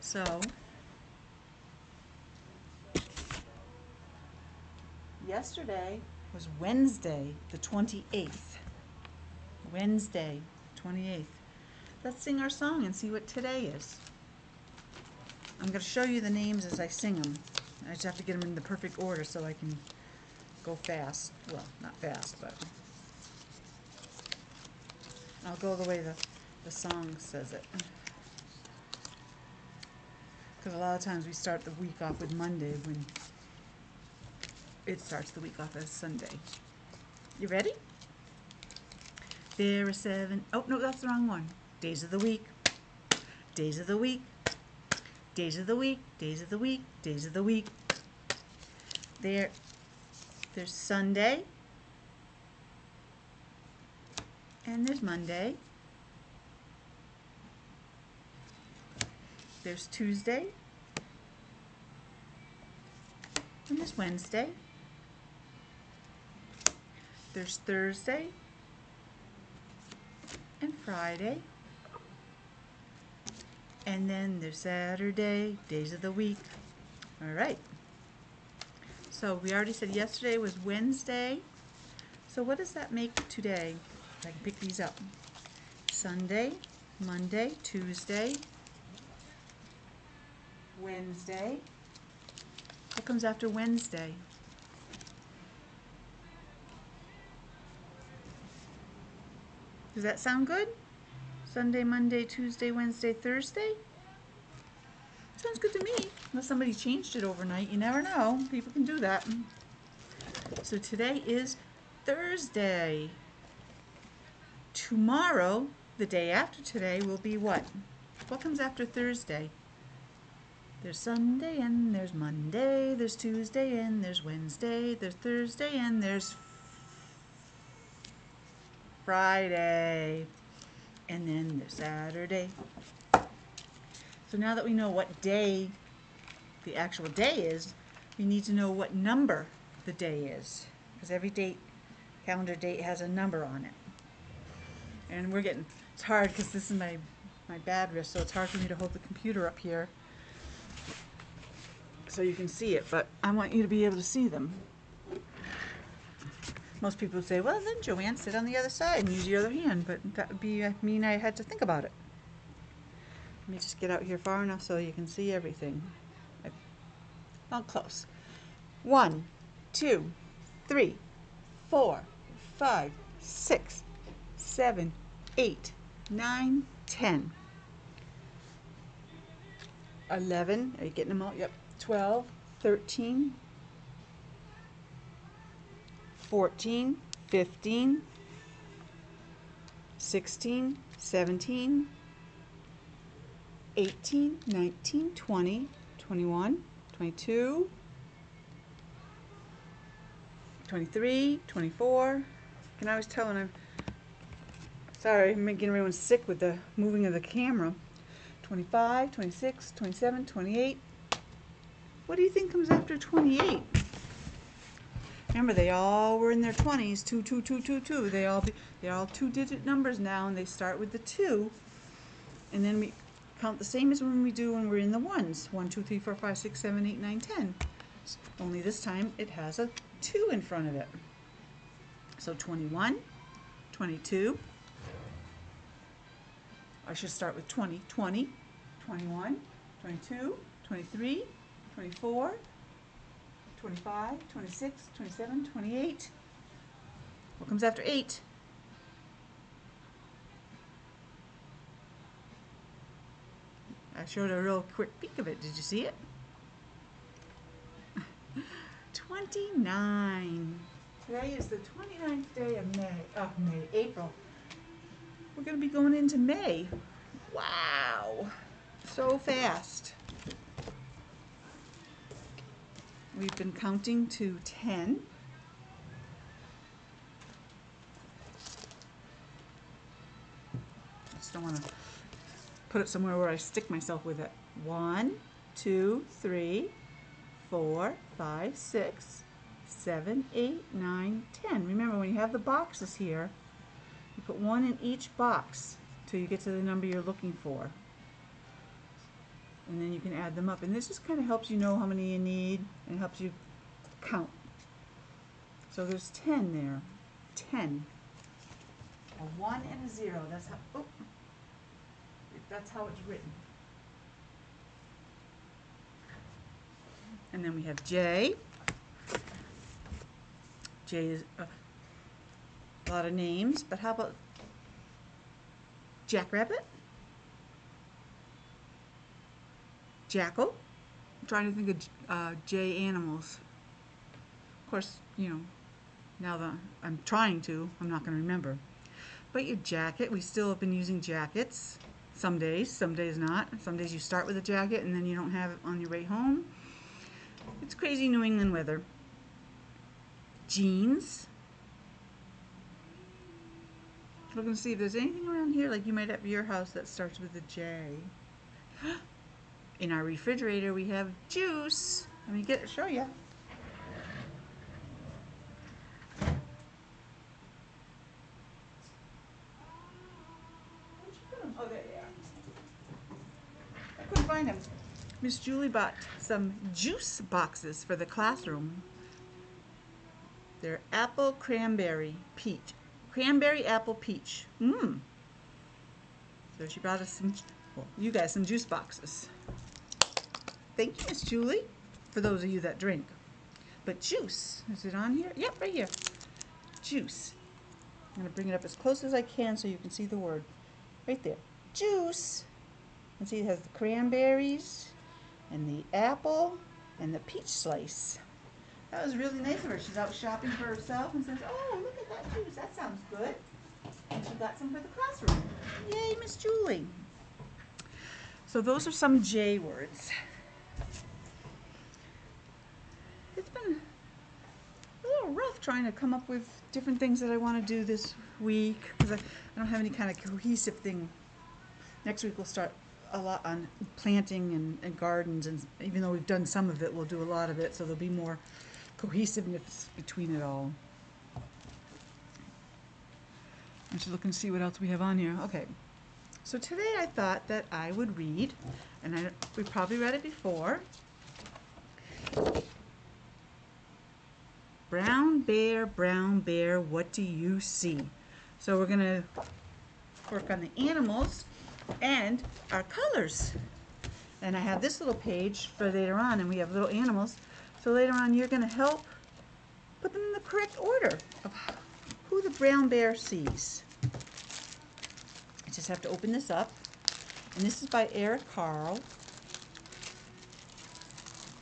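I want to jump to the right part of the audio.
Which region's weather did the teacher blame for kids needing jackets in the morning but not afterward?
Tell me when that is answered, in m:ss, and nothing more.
5:48.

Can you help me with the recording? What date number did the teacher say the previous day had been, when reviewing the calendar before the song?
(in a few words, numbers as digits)
28th.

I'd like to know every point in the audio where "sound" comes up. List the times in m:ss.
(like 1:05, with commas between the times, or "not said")
1:40, 1:45, 6:52.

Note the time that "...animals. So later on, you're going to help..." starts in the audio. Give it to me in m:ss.
7:46.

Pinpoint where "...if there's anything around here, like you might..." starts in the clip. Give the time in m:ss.
5:54.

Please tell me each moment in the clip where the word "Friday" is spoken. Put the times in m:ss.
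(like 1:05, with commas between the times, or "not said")
1:10, 2:09.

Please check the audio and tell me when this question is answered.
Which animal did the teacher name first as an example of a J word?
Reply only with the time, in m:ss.
5:26.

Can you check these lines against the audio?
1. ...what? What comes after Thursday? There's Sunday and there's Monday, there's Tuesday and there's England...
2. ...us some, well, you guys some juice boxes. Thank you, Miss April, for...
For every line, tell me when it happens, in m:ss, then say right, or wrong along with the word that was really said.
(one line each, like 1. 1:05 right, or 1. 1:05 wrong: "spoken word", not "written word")
1. 1:57 wrong: "Wednesday", not "England"
2. 6:27 wrong: "Julie", not "April".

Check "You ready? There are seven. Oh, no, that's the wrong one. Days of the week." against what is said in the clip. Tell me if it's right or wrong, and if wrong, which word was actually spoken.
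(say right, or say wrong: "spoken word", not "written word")
right.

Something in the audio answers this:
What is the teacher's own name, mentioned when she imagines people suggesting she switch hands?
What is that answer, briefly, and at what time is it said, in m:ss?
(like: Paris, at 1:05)
Joanne, at 2:37.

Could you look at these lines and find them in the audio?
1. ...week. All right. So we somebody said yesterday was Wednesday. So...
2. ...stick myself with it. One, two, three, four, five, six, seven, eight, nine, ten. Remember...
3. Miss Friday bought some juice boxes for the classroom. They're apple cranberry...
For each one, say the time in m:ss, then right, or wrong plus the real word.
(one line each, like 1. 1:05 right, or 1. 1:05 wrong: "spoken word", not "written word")
1. 1:16 wrong: "already", not "somebody"
2. 4:43 right
3. 6:15 wrong: "Julie", not "Friday".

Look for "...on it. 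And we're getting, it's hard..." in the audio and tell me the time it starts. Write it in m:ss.
2:23.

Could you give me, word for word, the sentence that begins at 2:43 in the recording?
Let me just get out here far enough so you can see everything.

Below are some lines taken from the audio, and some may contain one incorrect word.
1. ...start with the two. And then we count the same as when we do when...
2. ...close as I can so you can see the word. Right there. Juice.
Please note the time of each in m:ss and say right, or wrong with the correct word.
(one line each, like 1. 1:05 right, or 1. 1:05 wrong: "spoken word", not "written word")
1. 3:40 right
2. 6:38 right.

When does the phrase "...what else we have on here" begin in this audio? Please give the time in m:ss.
7:24.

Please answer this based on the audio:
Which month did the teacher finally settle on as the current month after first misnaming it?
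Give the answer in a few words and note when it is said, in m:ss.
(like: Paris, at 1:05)
April, at 4:23.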